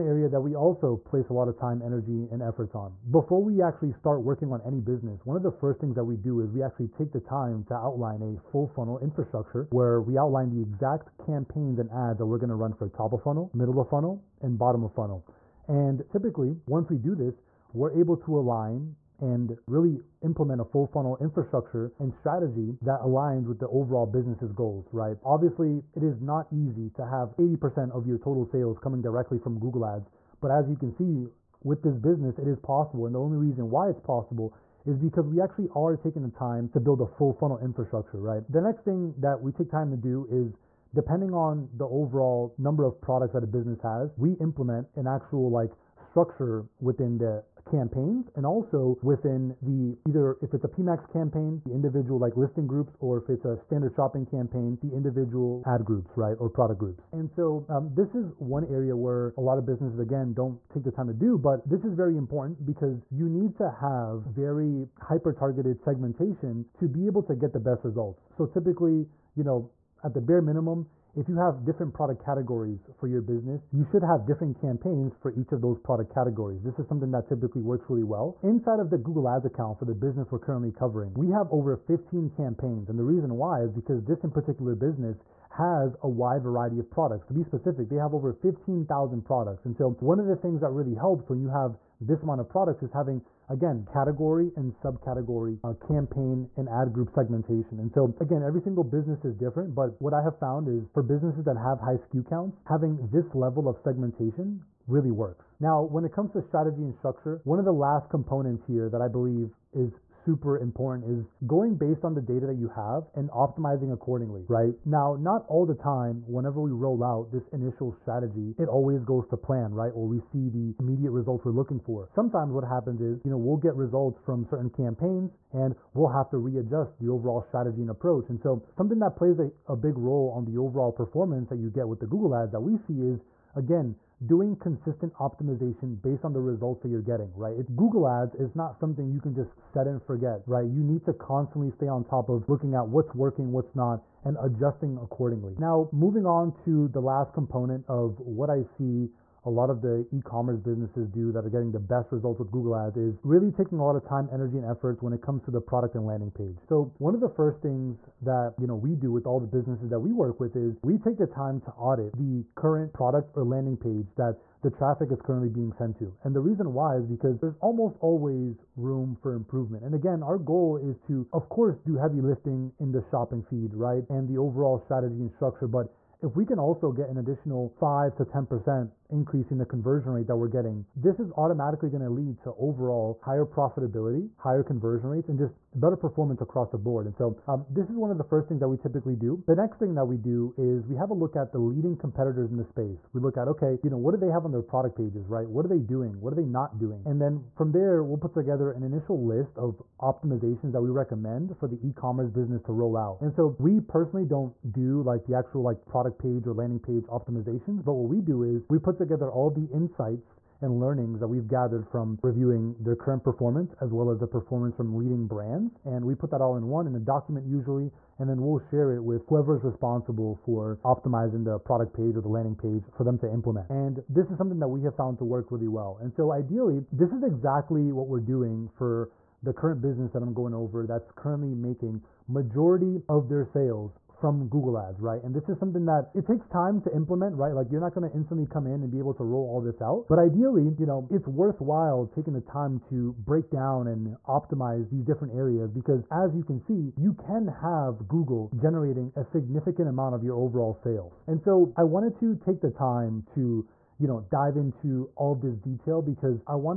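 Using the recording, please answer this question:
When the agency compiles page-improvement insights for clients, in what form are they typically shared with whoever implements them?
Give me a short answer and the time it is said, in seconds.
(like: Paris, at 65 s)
a document, at 216 s.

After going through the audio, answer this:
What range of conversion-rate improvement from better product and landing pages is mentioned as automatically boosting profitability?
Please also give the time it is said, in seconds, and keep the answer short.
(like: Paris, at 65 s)
5 to 10%, at 177 s.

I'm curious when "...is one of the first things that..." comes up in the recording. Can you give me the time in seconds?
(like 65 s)
187 s.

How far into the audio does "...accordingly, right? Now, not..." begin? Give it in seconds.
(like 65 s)
113 s.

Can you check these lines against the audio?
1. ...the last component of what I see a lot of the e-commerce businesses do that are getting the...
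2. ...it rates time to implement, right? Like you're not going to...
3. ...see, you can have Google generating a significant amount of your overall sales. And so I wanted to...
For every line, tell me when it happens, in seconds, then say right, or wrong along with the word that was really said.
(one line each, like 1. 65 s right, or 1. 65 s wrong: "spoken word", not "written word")
1. 146 s right
2. 236 s wrong: "takes", not "rates"
3. 246 s right.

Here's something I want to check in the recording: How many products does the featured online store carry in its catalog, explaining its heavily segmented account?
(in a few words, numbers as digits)
over 15,000.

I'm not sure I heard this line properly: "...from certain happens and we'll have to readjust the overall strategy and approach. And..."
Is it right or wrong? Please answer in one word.
wrong.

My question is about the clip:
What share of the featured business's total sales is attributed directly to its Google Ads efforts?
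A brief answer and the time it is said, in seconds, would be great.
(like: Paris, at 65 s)
80%, at 27 s.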